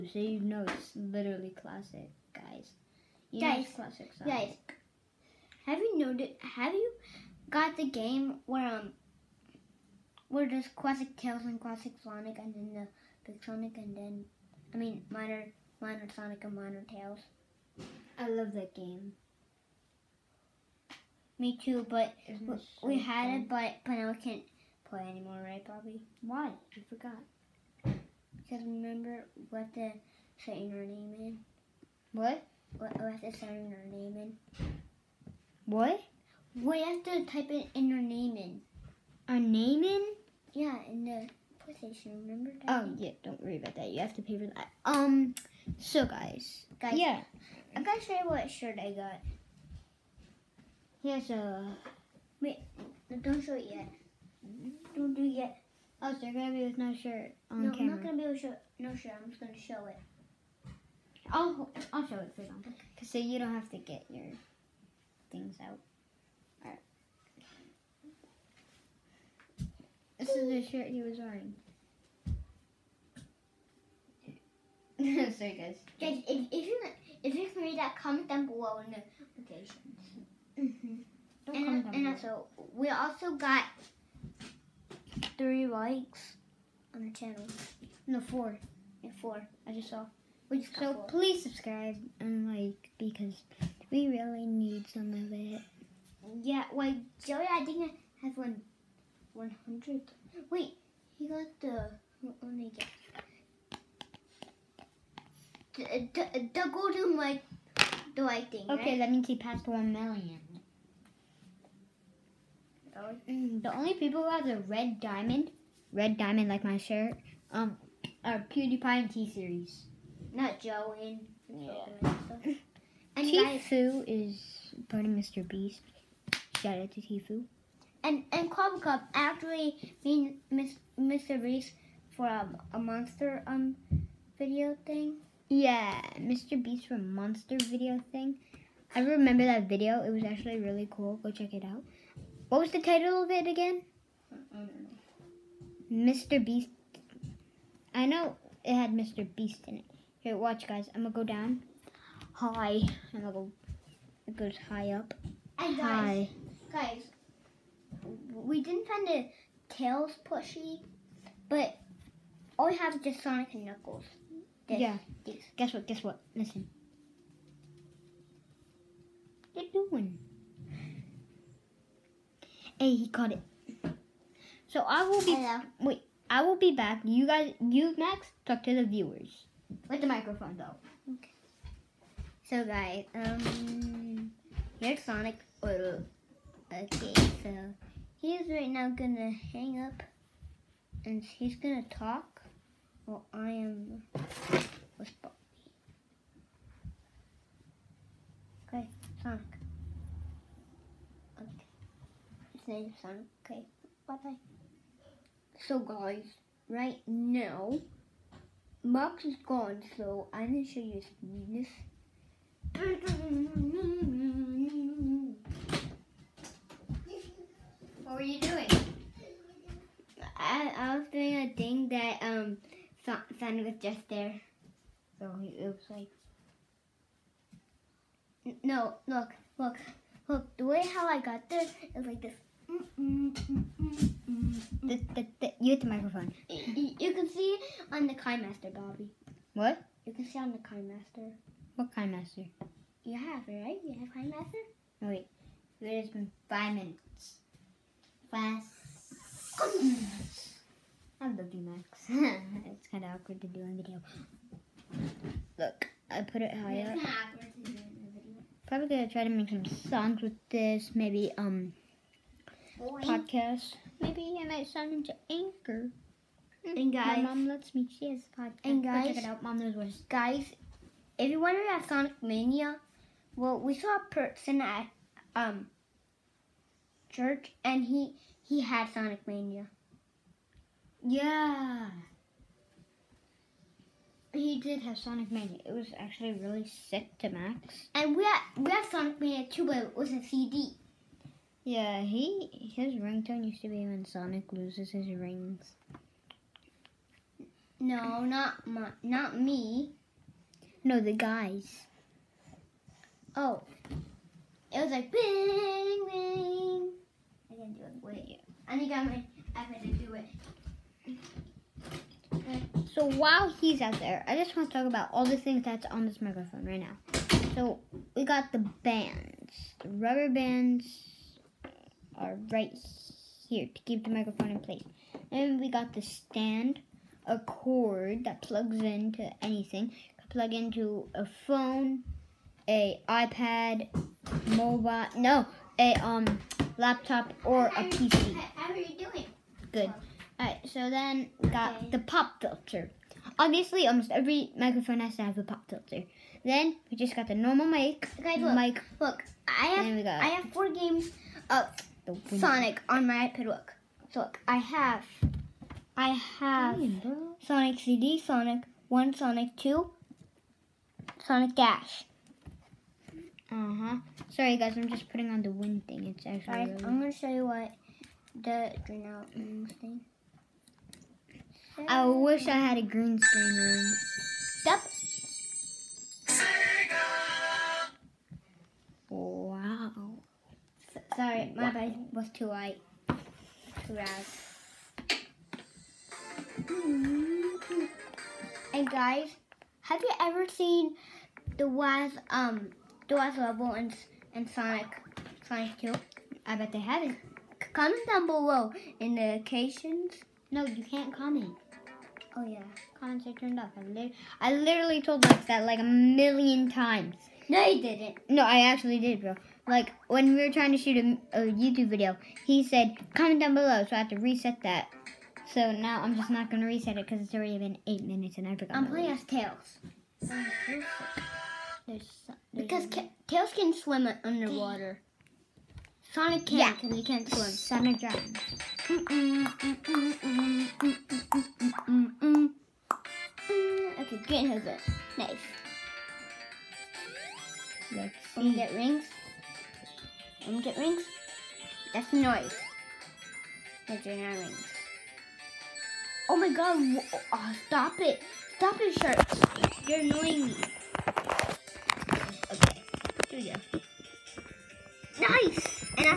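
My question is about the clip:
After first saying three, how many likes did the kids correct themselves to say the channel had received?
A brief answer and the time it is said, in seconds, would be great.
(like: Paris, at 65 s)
4, at 88 s.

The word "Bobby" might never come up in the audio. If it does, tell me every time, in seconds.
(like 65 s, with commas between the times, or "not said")
25 s, 195 s, 238 s.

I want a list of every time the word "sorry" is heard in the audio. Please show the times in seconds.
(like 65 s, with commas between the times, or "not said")
364 s, 381 s.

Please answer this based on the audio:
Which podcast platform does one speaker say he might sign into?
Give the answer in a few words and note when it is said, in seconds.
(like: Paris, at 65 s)
Anchor, at 265 s.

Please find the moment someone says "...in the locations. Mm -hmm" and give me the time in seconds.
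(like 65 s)
78 s.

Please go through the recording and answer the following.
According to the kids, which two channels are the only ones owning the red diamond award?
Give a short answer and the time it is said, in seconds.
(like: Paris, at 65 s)
PewDiePie and T Series, at 118 s.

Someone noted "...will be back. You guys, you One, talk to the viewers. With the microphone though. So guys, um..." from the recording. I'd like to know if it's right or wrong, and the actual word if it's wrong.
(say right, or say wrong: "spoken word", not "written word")
wrong: "Max", not "One".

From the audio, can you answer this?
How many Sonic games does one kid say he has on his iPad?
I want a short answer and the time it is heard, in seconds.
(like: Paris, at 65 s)
4, at 350 s.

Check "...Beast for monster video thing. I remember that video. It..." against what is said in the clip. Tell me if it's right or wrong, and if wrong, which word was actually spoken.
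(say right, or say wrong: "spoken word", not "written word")
right.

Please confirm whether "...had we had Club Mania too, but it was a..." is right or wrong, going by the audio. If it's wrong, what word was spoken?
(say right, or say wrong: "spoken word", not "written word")
wrong: "Sonic", not "Club".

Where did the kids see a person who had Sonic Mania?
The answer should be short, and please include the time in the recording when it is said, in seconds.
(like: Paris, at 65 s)
church, at 277 s.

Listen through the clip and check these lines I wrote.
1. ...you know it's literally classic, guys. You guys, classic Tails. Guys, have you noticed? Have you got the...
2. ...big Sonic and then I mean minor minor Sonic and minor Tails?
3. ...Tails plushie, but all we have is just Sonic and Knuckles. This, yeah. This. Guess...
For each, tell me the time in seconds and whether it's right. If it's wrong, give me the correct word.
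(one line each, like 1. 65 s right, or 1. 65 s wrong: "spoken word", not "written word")
1. 0 s wrong: "Sonic", not "Tails"
2. 13 s right
3. 159 s right.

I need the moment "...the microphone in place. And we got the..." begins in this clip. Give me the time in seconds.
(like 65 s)
324 s.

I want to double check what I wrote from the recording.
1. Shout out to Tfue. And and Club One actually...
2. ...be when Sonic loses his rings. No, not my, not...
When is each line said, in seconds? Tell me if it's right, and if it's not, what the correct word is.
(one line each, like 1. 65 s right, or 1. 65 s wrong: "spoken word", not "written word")
1. 126 s wrong: "Cup", not "One"
2. 293 s right.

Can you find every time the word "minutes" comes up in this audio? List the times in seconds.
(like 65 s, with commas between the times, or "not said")
246 s, 418 s.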